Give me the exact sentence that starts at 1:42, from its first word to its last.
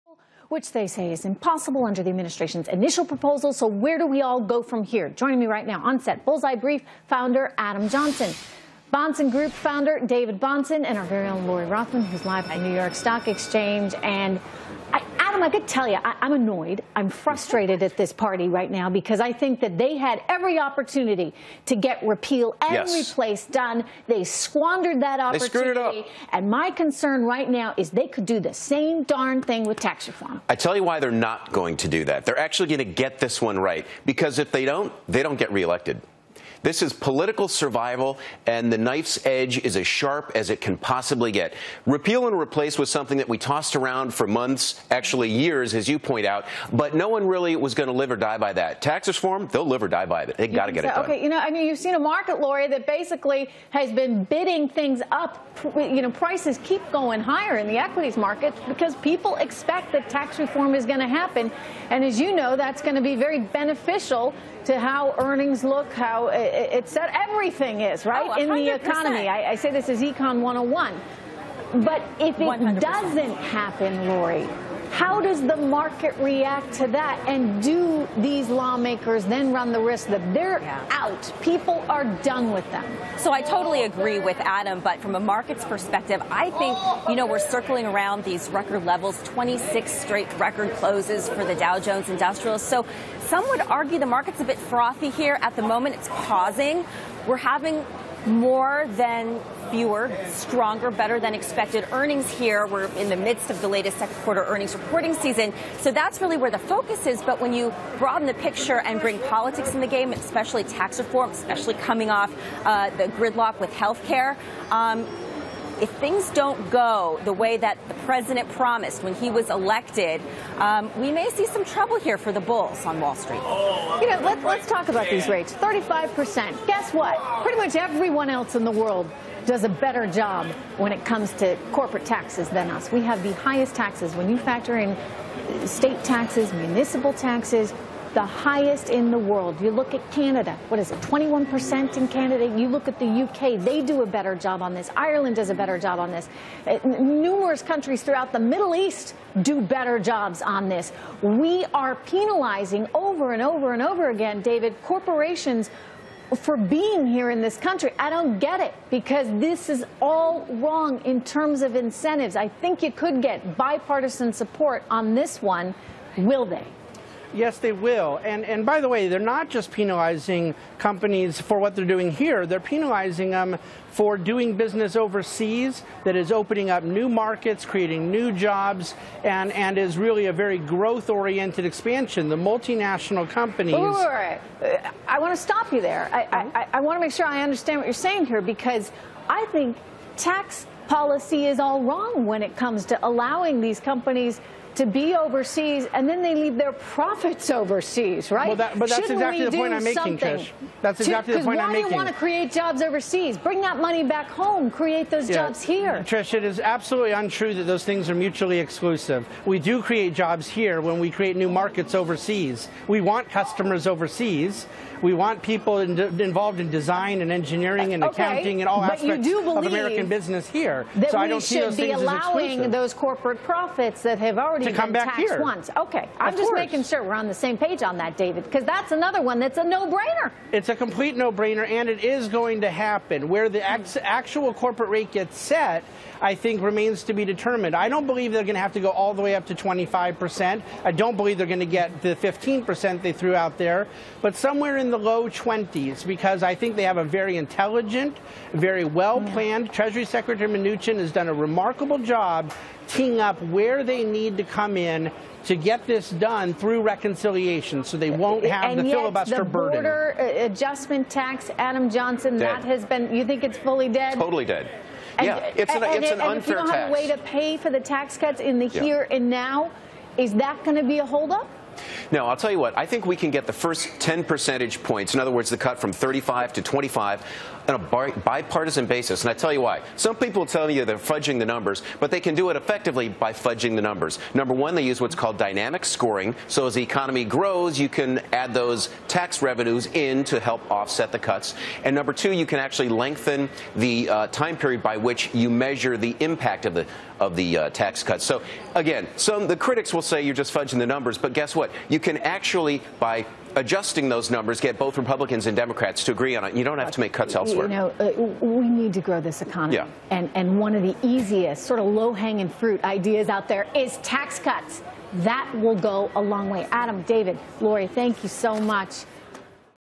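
We're in the midst of the latest second quarter earnings reporting season.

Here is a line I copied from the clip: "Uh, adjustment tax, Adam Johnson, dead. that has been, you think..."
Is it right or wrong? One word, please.
right.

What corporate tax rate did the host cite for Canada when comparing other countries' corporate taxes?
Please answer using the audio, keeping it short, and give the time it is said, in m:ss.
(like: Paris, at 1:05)
21%, at 2:21.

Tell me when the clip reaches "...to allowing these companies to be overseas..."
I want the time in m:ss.
3:12.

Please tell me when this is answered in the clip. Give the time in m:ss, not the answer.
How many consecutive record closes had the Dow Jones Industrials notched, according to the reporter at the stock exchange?
1:29.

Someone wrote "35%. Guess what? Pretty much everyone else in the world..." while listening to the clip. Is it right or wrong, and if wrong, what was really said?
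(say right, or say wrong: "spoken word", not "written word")
right.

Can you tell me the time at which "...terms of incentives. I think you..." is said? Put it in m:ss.
2:41.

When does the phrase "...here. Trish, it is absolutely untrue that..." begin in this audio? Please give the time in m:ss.
3:25.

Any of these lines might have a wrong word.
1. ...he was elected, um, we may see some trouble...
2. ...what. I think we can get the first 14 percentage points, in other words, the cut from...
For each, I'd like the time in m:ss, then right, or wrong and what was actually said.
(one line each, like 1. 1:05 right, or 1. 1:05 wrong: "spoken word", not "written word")
1. 1:59 right
2. 4:32 wrong: "10", not "14".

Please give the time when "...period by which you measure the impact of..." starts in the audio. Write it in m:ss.
4:54.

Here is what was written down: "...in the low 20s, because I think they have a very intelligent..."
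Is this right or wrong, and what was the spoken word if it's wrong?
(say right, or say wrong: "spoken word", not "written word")
right.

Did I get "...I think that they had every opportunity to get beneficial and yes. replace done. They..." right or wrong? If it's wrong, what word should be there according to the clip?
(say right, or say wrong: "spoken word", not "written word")
wrong: "repeal", not "beneficial".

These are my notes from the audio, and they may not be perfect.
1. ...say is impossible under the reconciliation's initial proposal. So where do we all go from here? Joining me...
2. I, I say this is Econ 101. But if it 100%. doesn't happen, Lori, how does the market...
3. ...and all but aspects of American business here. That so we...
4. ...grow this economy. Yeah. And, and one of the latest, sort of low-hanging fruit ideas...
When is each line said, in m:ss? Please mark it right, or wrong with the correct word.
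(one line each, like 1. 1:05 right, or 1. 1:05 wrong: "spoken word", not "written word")
1. 0:00 wrong: "administration", not "reconciliation"
2. 1:09 right
3. 3:38 right
4. 5:09 wrong: "easiest", not "latest".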